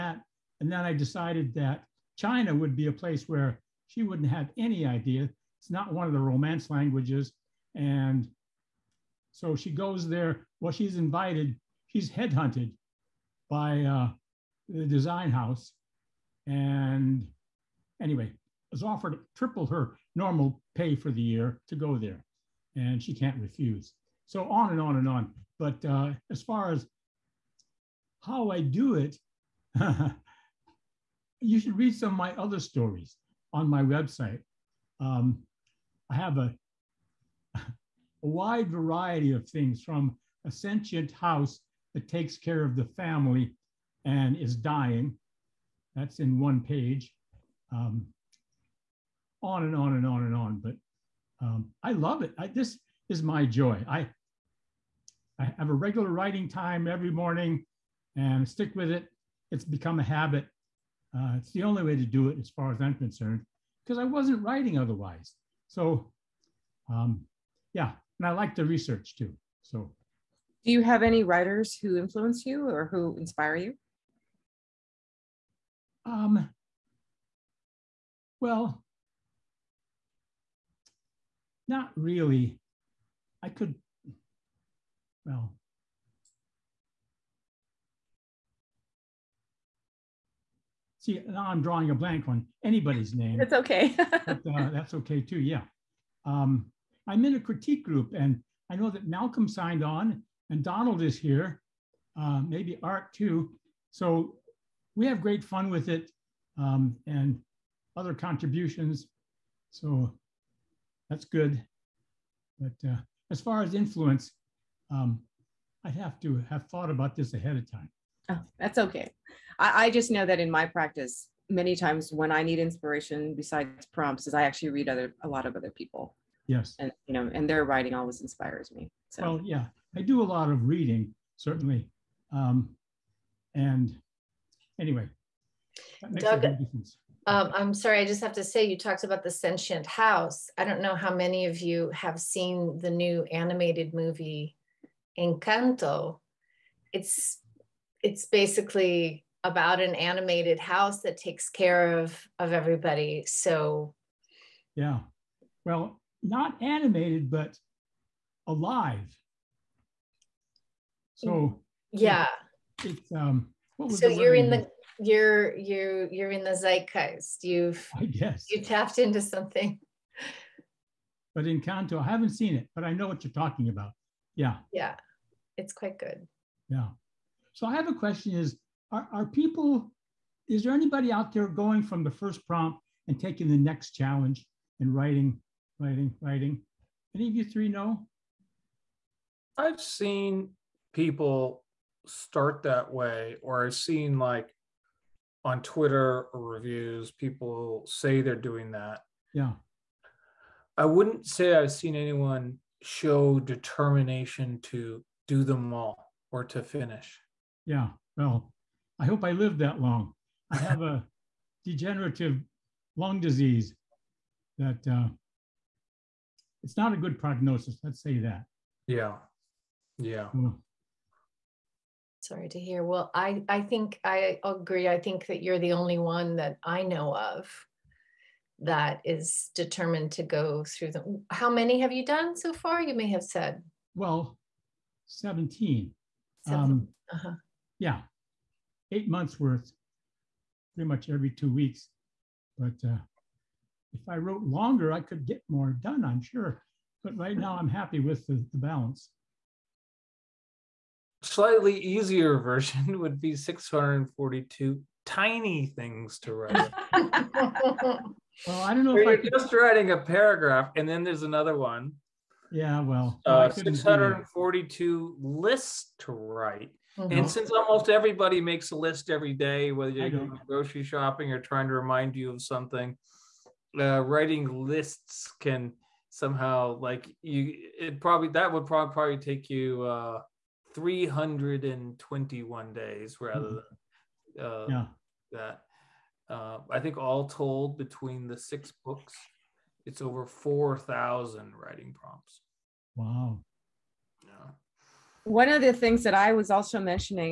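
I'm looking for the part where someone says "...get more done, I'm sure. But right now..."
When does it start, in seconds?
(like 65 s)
245 s.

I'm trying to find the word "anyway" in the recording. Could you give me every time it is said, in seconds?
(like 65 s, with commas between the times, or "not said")
18 s, 134 s.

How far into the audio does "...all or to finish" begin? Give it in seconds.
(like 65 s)
205 s.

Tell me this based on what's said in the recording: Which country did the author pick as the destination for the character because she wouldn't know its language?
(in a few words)
China.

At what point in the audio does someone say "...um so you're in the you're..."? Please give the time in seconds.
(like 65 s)
163 s.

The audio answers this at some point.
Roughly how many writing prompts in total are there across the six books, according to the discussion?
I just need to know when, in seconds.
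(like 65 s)
290 s.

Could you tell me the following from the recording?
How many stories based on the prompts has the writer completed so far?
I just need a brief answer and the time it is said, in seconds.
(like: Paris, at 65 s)
17, at 235 s.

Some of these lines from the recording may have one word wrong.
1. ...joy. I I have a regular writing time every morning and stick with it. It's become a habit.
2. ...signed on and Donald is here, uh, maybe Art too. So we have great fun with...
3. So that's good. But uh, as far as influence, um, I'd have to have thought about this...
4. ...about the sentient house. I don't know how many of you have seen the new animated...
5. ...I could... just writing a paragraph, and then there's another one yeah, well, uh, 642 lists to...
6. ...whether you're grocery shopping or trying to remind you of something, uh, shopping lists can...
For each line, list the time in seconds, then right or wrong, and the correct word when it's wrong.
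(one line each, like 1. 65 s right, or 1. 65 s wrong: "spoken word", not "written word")
1. 53 s right
2. 99 s right
3. 109 s right
4. 139 s right
5. 259 s right
6. 269 s wrong: "writing", not "shopping".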